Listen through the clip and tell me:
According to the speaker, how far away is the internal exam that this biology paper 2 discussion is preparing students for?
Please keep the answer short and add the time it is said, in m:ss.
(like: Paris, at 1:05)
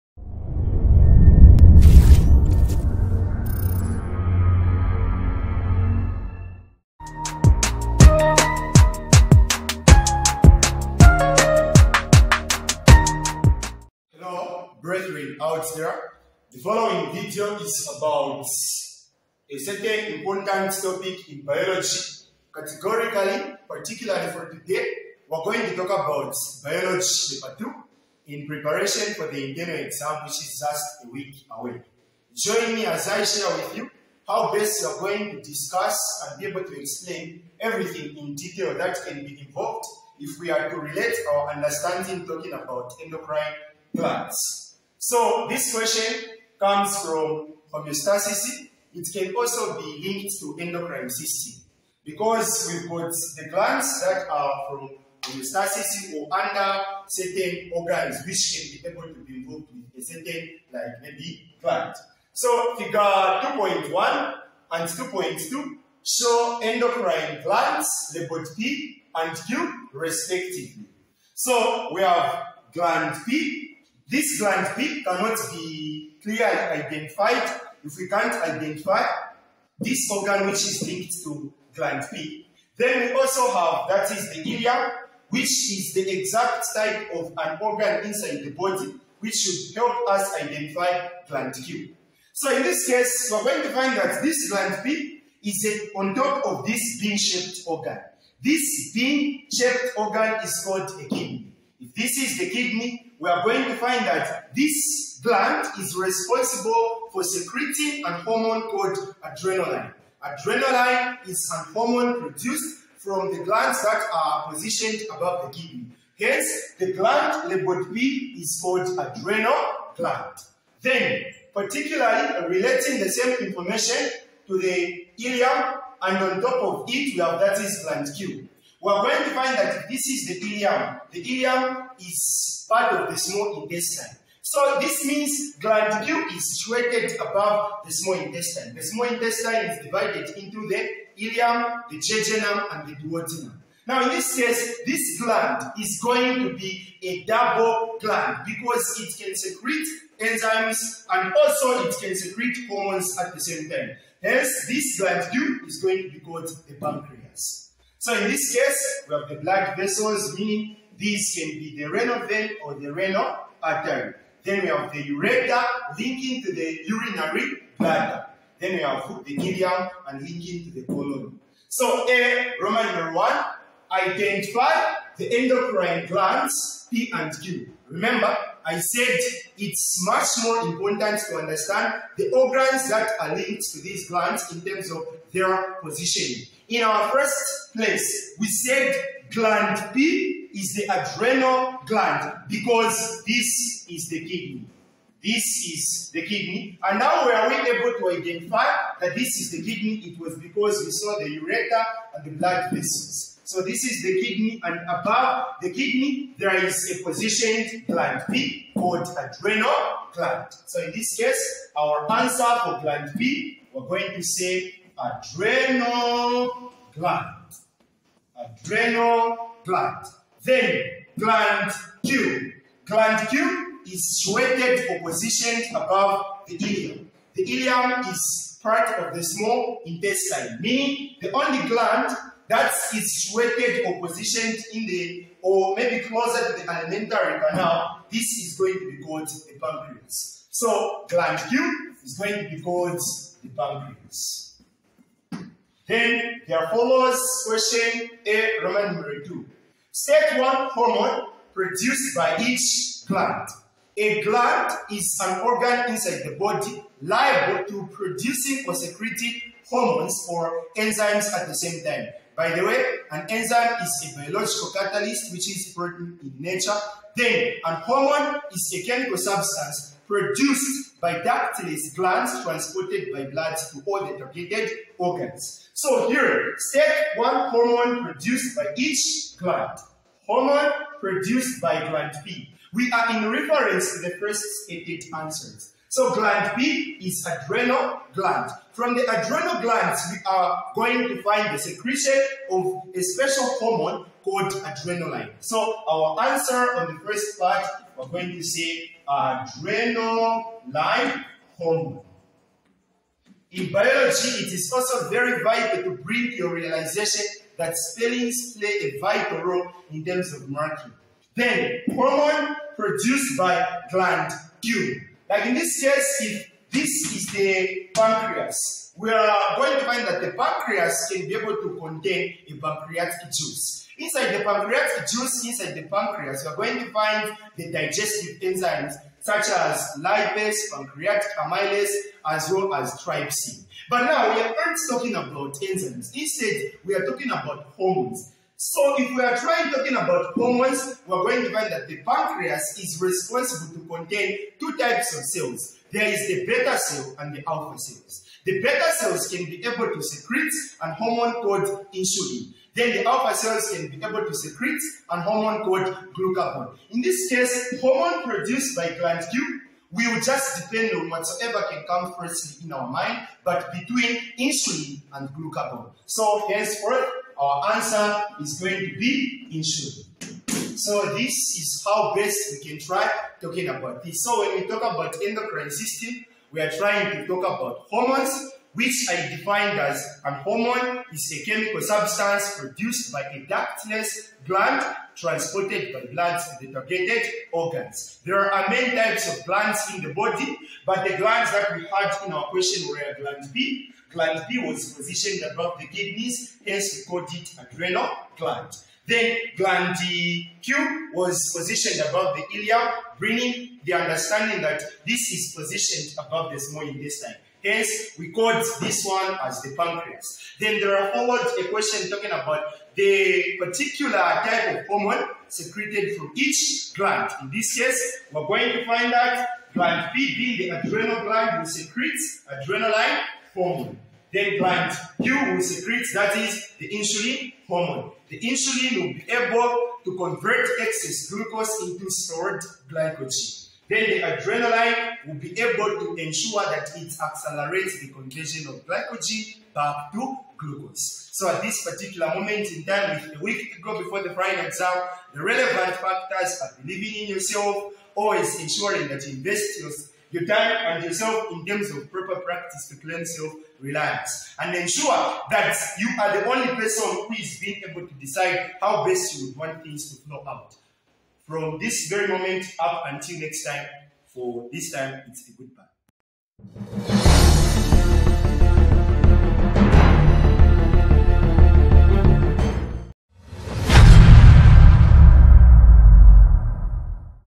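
A week away, at 0:30.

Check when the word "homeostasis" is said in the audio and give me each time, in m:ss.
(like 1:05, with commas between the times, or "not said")
0:47, 0:55.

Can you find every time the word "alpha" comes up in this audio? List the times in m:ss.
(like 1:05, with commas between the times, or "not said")
5:47, 5:53.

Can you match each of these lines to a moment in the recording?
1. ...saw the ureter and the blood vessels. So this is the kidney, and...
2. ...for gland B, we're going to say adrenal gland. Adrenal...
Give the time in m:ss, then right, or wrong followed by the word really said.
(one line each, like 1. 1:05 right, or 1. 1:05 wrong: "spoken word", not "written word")
1. 3:20 right
2. 3:32 right.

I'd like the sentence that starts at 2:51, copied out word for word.
So A, Roman number 1, identify the endocrine glands P and Q.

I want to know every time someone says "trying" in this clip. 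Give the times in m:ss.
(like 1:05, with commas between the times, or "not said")
5:39, 6:16.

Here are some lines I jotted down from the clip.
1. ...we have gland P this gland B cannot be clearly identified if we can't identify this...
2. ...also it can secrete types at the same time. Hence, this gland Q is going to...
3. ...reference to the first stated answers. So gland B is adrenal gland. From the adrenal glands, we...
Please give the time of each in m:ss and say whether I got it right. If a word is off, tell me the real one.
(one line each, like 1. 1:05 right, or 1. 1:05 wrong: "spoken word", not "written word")
1. 1:11 right
2. 2:31 wrong: "hormones", not "types"
3. 4:43 right.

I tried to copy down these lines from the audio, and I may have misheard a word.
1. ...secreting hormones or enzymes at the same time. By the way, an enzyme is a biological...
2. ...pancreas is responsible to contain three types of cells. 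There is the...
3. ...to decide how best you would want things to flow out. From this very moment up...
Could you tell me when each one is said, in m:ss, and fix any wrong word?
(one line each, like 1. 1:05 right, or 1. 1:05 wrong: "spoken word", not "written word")
1. 4:18 right
2. 5:42 wrong: "two", not "three"
3. 7:38 right.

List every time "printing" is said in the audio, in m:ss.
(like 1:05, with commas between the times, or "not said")
not said.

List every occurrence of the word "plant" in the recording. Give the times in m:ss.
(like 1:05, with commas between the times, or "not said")
0:43, 1:01, 7:04.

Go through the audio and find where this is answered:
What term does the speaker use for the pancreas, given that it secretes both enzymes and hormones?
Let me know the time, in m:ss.
2:27.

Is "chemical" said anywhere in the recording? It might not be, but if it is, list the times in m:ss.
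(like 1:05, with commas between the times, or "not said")
4:28, 6:21.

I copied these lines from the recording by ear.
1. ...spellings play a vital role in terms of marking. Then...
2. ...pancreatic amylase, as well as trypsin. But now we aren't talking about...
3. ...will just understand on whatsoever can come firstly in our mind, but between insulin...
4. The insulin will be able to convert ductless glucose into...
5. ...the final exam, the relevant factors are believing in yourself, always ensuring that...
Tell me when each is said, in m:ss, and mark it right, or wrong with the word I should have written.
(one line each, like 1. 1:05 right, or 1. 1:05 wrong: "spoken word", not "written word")
1. 5:07 right
2. 5:30 right
3. 5:59 wrong: "depend", not "understand"
4. 7:08 wrong: "excess", not "ductless"
5. 7:24 right.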